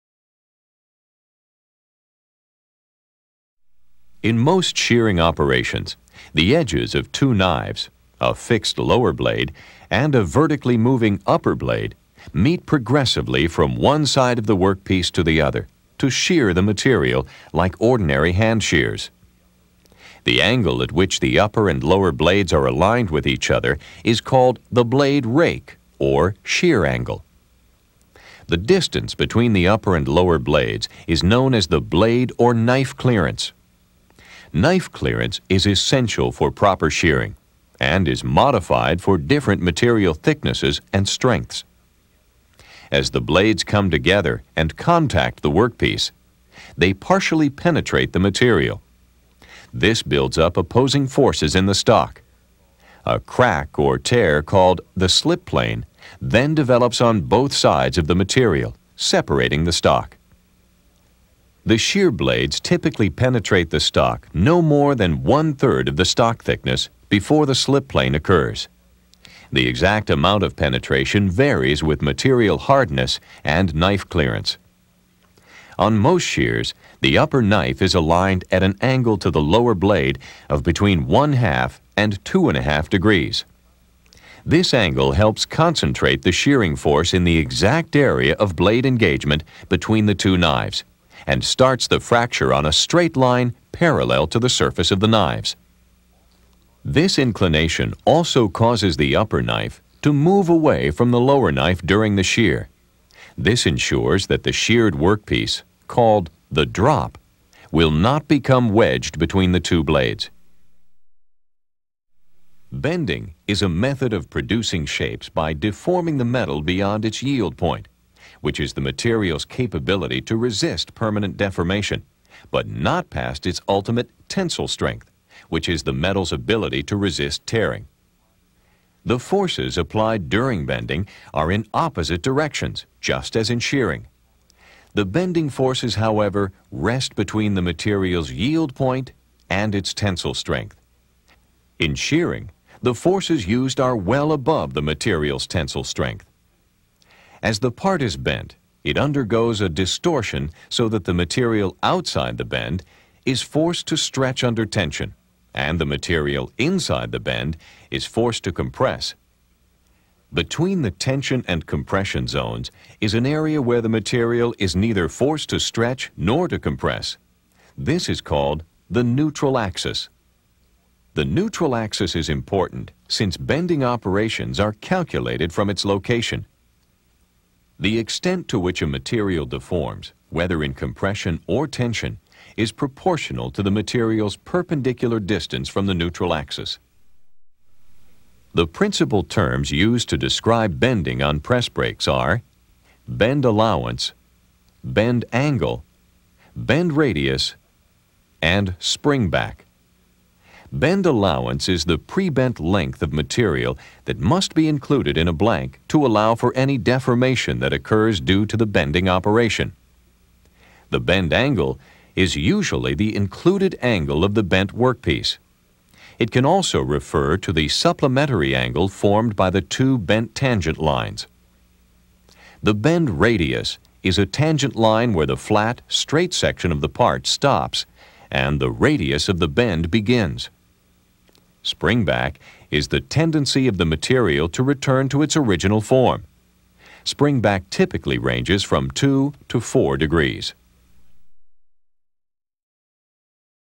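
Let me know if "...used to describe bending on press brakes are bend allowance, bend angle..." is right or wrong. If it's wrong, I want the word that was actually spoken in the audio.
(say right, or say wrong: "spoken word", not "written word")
right.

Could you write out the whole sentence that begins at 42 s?
As the blades come together and contact the workpiece, they partially penetrate the material.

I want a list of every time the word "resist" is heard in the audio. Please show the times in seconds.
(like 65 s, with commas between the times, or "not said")
120 s, 126 s.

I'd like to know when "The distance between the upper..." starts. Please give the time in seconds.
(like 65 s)
28 s.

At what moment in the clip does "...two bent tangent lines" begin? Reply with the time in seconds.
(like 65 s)
219 s.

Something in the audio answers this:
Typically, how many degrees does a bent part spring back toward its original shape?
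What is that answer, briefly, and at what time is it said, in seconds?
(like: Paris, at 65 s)
2 to 4 degrees, at 238 s.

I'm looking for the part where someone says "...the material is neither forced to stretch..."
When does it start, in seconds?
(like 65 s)
163 s.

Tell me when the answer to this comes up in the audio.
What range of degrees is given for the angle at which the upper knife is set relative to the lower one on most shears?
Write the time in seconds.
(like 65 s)
81 s.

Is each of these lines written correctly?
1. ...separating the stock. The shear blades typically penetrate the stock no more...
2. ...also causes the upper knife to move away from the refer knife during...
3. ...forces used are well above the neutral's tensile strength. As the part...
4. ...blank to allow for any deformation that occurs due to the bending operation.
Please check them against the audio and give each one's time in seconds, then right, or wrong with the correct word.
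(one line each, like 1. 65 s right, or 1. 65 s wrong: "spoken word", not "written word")
1. 58 s right
2. 98 s wrong: "lower", not "refer"
3. 142 s wrong: "material", not "neutral"
4. 205 s right.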